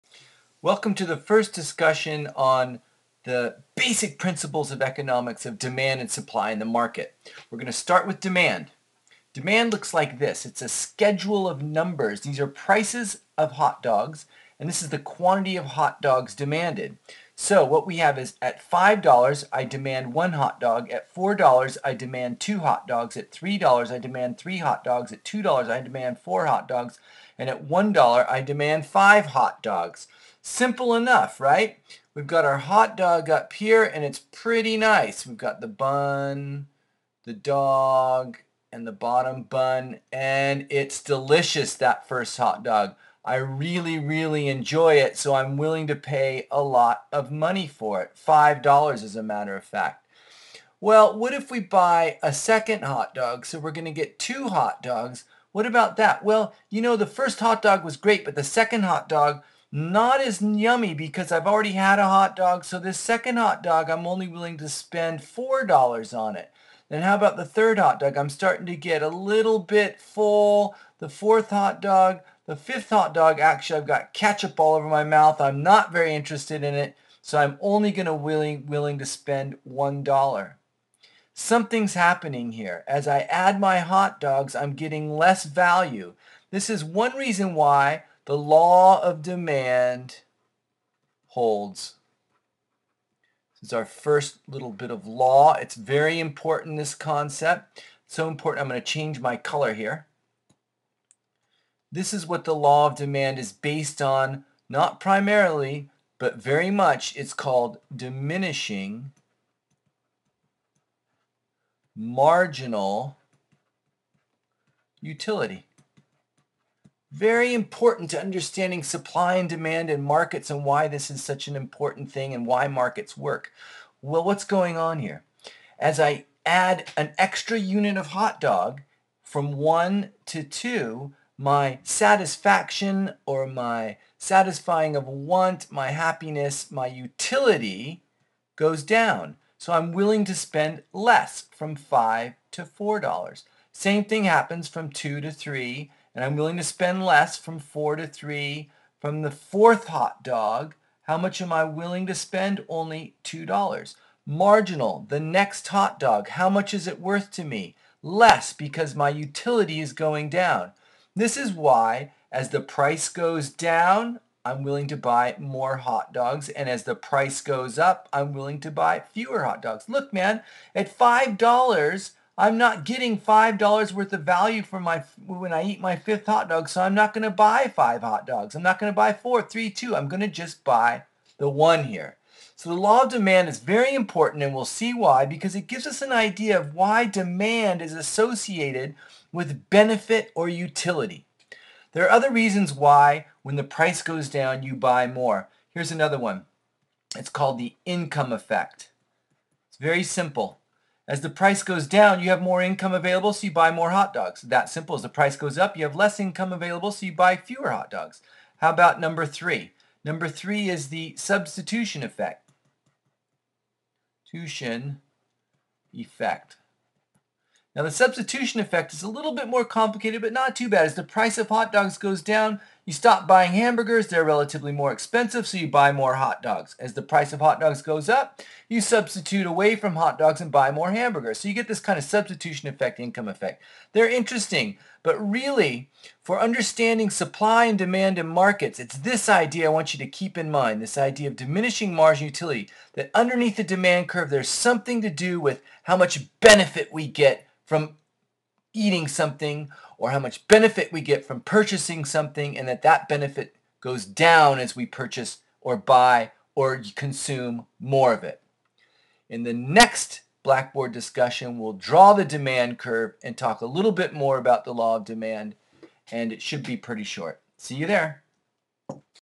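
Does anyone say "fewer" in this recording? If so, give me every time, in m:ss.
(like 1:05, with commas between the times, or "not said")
2:49, 3:27.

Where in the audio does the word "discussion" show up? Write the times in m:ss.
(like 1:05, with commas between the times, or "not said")
0:01, 4:20.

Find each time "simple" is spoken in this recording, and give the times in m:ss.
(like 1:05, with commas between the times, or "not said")
0:30, 3:20, 3:24.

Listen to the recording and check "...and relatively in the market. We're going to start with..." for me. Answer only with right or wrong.
wrong.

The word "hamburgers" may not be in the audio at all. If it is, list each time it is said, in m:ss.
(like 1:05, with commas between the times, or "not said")
3:43, 3:50.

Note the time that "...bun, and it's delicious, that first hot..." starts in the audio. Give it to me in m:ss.
0:39.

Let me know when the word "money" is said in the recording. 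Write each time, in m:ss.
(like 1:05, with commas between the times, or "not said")
0:47.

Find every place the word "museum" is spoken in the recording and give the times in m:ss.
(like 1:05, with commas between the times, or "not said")
not said.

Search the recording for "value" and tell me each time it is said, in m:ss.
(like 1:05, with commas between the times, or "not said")
1:25, 2:54.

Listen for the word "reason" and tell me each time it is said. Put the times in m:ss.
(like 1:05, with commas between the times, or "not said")
1:27, 3:12.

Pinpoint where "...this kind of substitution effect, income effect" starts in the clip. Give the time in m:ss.
3:51.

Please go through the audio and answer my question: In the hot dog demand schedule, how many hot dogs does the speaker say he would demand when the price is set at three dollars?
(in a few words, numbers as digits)
3.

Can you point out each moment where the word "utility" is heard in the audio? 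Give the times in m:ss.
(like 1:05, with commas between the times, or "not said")
1:55, 2:16, 2:39, 3:10, 4:02.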